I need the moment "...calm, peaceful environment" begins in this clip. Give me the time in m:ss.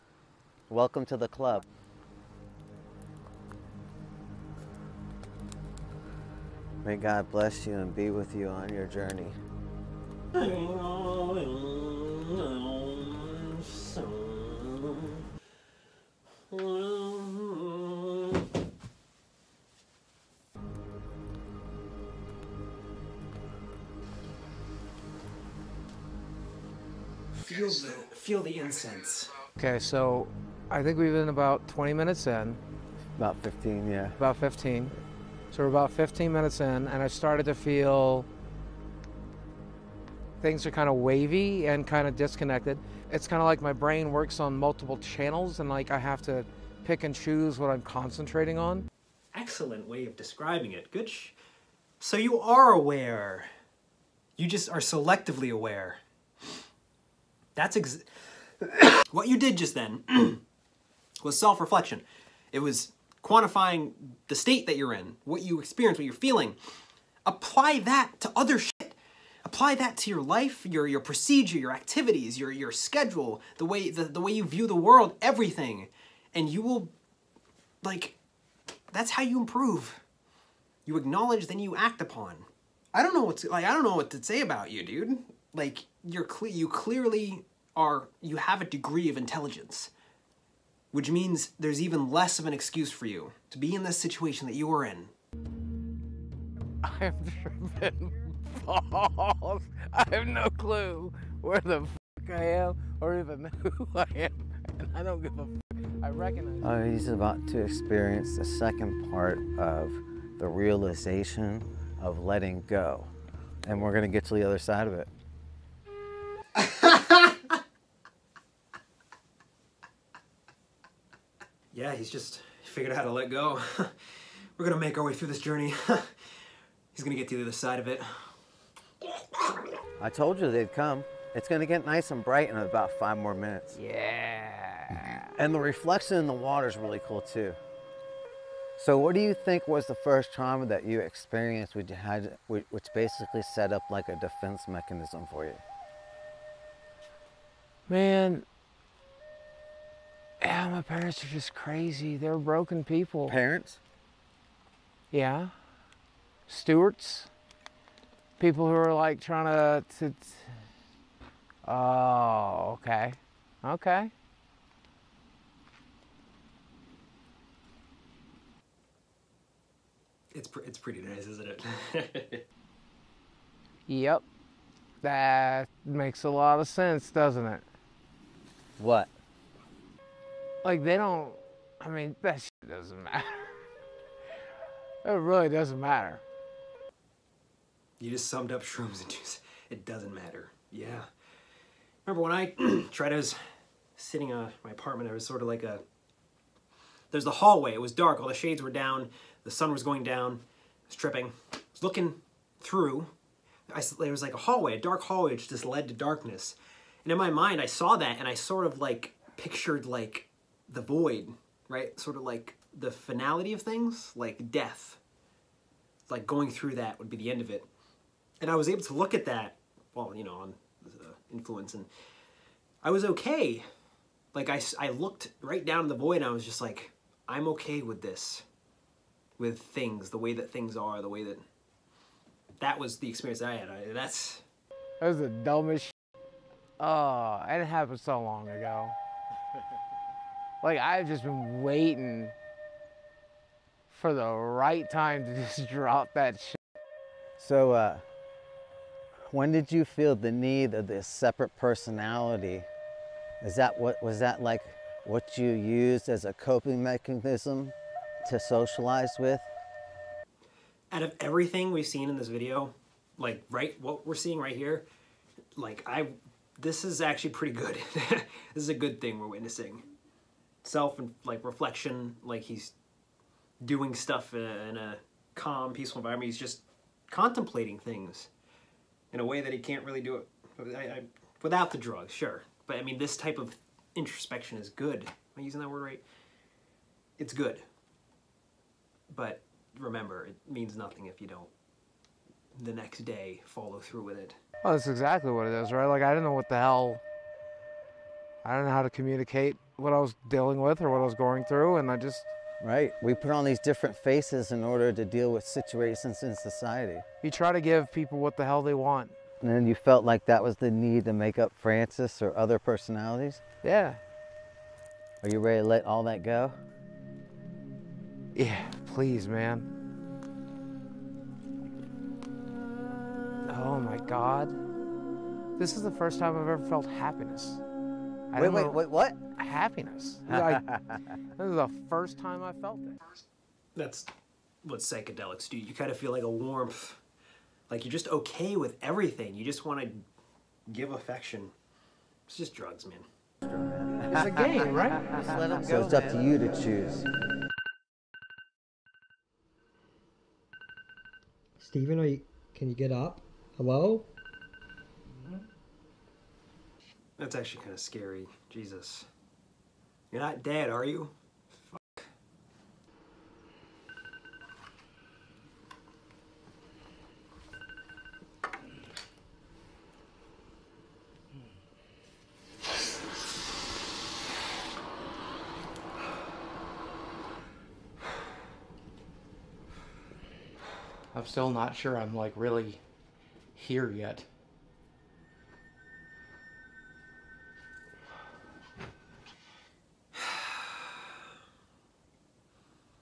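4:35.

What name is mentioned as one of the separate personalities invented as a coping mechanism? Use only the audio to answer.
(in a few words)
Francis.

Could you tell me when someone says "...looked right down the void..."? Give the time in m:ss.
3:44.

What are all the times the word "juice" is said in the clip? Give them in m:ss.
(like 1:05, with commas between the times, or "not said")
3:09.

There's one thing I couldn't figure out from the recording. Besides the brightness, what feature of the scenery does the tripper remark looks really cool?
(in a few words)
reflection in the water.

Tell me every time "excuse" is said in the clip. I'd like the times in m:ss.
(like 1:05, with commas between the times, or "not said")
1:32.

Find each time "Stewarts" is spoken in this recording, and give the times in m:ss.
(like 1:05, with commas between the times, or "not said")
2:36.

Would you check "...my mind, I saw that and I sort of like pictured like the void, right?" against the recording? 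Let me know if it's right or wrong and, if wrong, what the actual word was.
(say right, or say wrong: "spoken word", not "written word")
right.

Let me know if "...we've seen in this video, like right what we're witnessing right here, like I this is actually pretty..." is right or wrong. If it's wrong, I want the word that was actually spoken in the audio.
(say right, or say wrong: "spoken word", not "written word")
wrong: "seeing", not "witnessing".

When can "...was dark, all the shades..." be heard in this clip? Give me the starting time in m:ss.
3:17.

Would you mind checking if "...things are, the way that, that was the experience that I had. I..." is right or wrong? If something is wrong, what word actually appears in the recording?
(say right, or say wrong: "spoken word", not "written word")
right.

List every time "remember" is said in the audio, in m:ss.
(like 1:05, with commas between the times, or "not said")
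3:12, 4:49.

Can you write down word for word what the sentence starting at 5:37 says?
Like you're just okay with everything.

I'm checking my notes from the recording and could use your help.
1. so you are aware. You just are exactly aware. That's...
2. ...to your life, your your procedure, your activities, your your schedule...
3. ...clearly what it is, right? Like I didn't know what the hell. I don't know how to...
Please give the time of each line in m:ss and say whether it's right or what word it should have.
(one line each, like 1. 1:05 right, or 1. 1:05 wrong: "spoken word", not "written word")
1. 0:51 wrong: "selectively", not "exactly"
2. 1:09 right
3. 4:54 wrong: "exactly", not "clearly".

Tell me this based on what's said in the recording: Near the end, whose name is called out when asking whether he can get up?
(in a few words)
Steven.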